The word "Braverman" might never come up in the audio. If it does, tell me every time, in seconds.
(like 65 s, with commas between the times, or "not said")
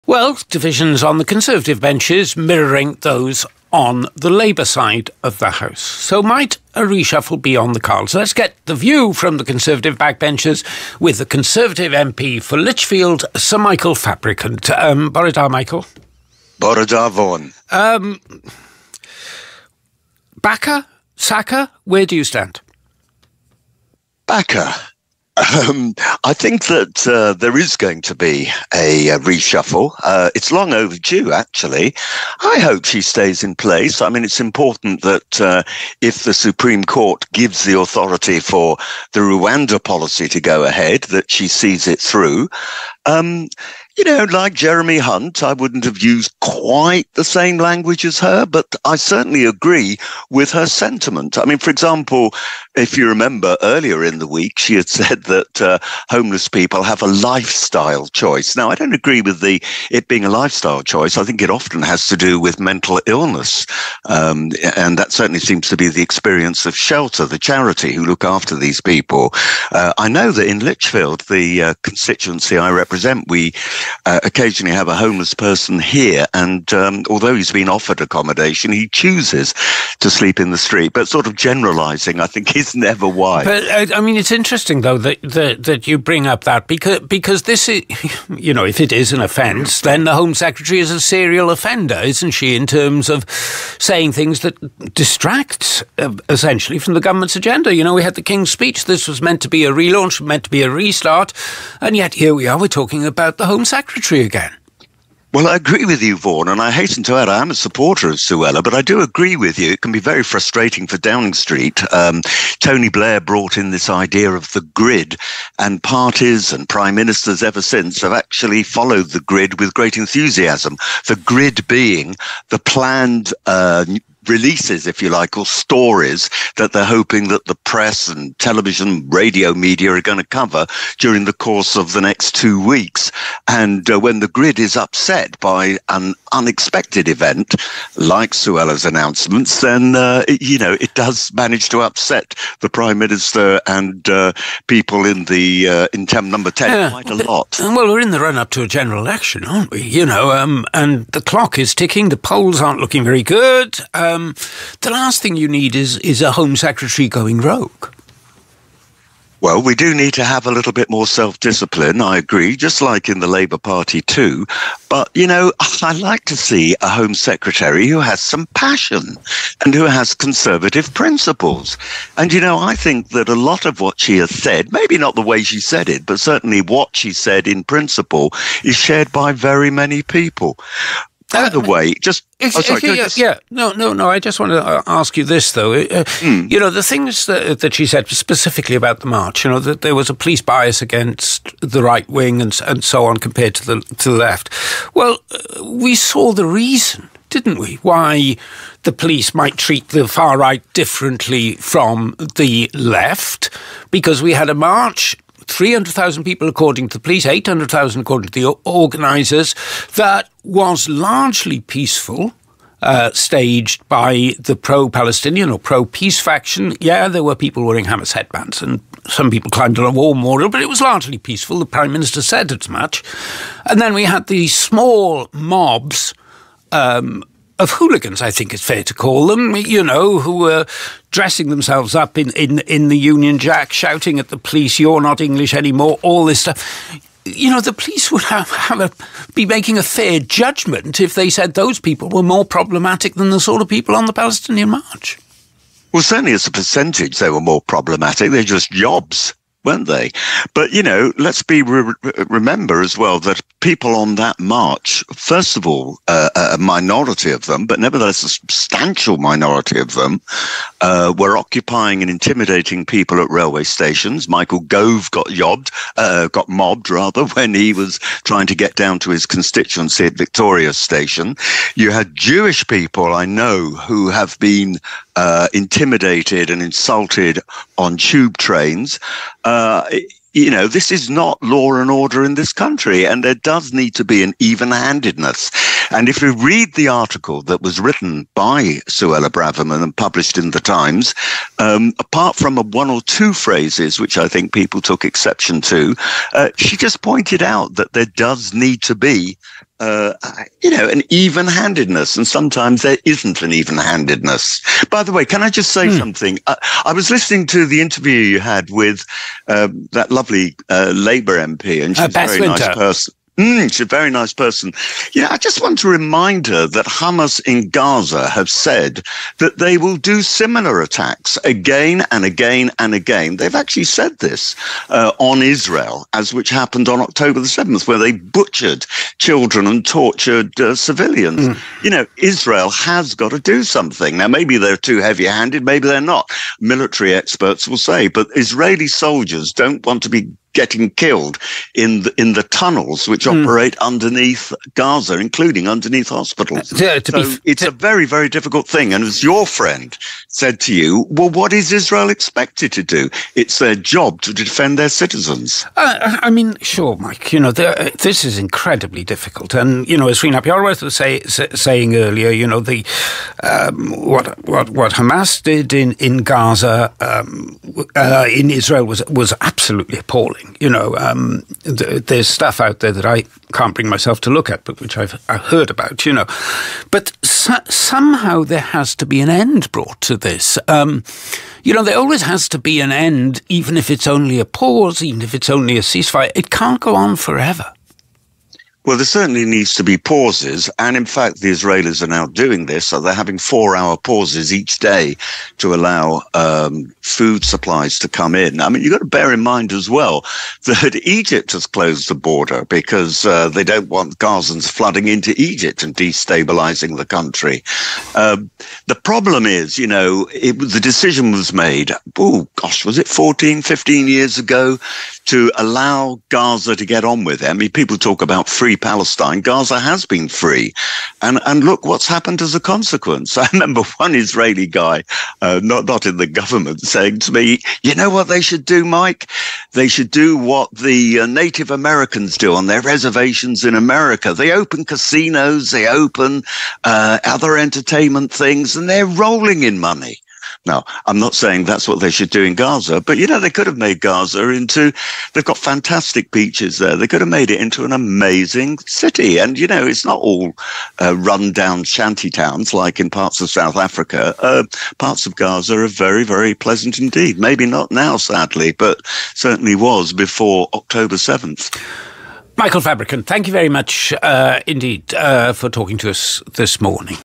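289 s.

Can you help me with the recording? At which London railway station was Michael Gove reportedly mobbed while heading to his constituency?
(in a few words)
Victoria Station.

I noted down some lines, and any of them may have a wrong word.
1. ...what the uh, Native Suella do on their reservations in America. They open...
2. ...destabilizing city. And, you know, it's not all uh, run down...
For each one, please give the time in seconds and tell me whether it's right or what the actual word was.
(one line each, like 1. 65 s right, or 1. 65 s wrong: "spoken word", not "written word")
1. 430 s wrong: "Americans", not "Suella"
2. 447 s wrong: "amazing", not "destabilizing".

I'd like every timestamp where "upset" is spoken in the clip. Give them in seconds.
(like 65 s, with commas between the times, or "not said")
134 s, 141 s.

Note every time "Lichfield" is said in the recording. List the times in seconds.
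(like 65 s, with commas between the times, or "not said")
12 s, 70 s.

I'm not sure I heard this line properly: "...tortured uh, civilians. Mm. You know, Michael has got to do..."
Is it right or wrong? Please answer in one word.
wrong.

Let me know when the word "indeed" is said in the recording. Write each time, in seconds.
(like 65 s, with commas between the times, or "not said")
456 s, 464 s.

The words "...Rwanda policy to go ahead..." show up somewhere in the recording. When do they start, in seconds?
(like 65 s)
39 s.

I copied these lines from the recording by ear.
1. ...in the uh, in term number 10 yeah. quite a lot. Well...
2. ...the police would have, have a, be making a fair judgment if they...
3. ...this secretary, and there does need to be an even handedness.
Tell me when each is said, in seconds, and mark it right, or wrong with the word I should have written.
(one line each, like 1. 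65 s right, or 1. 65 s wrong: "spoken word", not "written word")
1. 145 s right
2. 237 s right
3. 282 s wrong: "country", not "secretary".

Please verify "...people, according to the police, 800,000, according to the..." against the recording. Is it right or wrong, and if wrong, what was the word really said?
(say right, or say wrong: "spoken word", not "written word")
right.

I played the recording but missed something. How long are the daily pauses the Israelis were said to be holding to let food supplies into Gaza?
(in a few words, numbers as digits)
4 hours.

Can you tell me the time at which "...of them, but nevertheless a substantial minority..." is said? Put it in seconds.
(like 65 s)
257 s.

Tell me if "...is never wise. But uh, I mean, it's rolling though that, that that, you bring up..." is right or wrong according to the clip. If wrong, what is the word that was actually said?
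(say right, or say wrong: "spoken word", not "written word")
wrong: "interesting", not "rolling".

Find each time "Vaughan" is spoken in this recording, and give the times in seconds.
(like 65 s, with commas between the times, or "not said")
17 s, 106 s.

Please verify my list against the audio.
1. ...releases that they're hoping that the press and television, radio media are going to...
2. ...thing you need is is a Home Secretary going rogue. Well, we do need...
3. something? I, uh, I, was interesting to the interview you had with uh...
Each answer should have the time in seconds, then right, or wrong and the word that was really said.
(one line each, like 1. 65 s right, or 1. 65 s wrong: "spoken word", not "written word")
1. 125 s wrong: "stories", not "releases"
2. 155 s right
3. 305 s wrong: "listening", not "interesting".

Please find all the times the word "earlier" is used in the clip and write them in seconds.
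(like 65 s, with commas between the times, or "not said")
53 s, 361 s.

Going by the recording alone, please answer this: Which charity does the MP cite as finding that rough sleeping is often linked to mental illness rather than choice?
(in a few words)
Shelter.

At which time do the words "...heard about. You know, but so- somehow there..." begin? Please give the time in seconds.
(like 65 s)
375 s.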